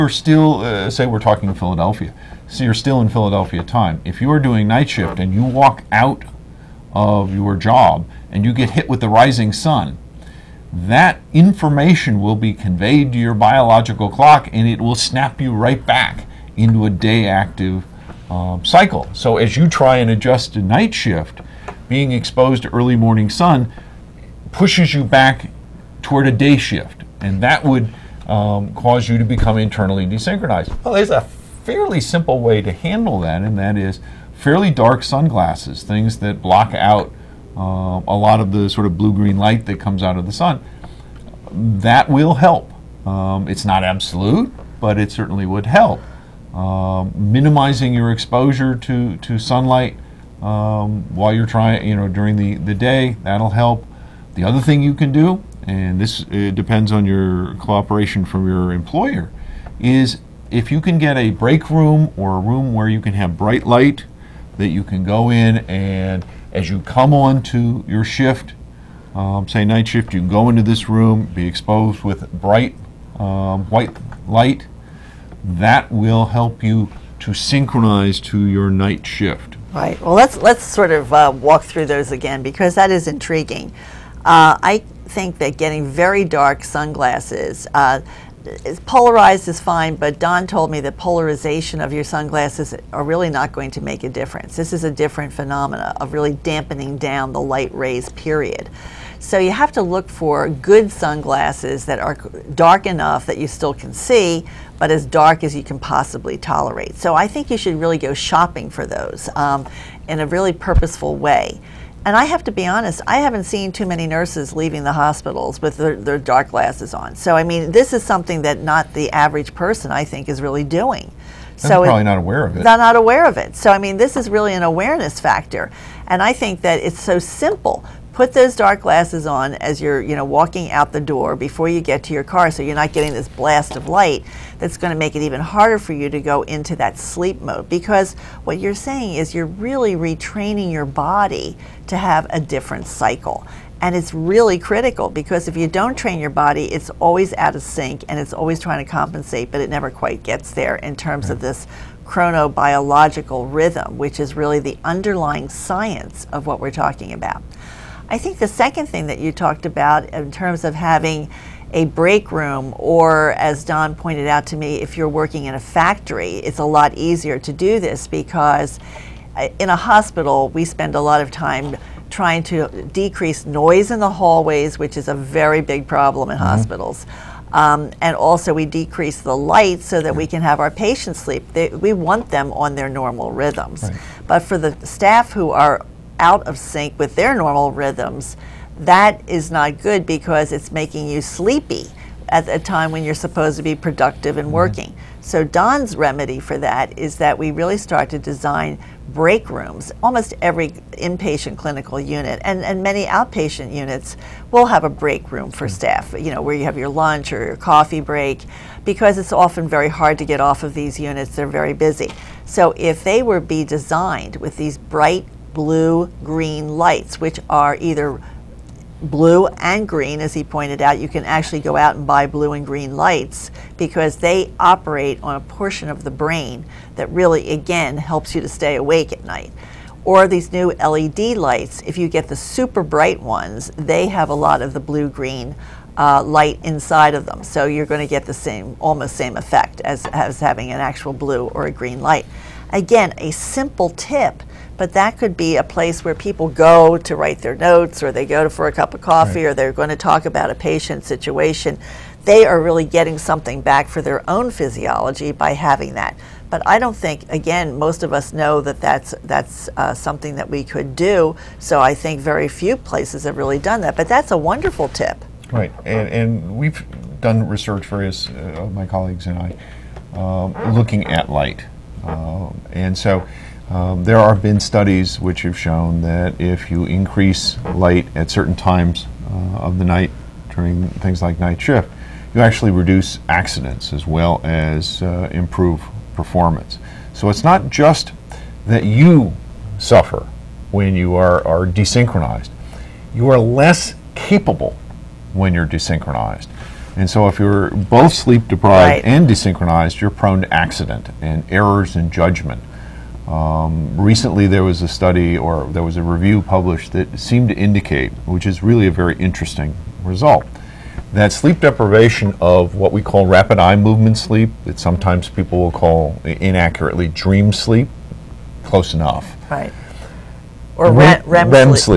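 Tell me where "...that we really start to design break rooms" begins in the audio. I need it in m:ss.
3:17.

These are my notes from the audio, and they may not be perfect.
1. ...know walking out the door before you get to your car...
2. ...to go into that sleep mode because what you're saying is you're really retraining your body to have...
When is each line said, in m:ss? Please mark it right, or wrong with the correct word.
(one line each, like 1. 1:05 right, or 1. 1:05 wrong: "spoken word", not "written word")
1. 2:10 right
2. 2:16 right.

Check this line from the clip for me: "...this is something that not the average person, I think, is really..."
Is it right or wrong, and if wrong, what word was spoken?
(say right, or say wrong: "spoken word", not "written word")
right.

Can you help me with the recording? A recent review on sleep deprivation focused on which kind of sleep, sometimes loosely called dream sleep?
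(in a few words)
rapid eye movement sleep.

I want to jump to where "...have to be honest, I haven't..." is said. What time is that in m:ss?
1:52.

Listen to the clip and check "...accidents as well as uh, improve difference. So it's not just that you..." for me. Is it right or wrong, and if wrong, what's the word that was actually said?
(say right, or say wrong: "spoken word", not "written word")
wrong: "performance", not "difference".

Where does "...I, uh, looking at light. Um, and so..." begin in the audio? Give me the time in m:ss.
4:29.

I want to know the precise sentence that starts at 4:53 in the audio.
You are less capable when you're desynchronized.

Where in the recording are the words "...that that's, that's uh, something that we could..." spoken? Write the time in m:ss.
4:18.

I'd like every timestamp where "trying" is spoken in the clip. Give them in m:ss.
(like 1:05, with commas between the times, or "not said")
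0:51, 2:28, 2:52.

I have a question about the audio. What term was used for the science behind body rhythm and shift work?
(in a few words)
chronobiological rhythm.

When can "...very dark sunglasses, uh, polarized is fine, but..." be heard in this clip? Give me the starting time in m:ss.
1:25.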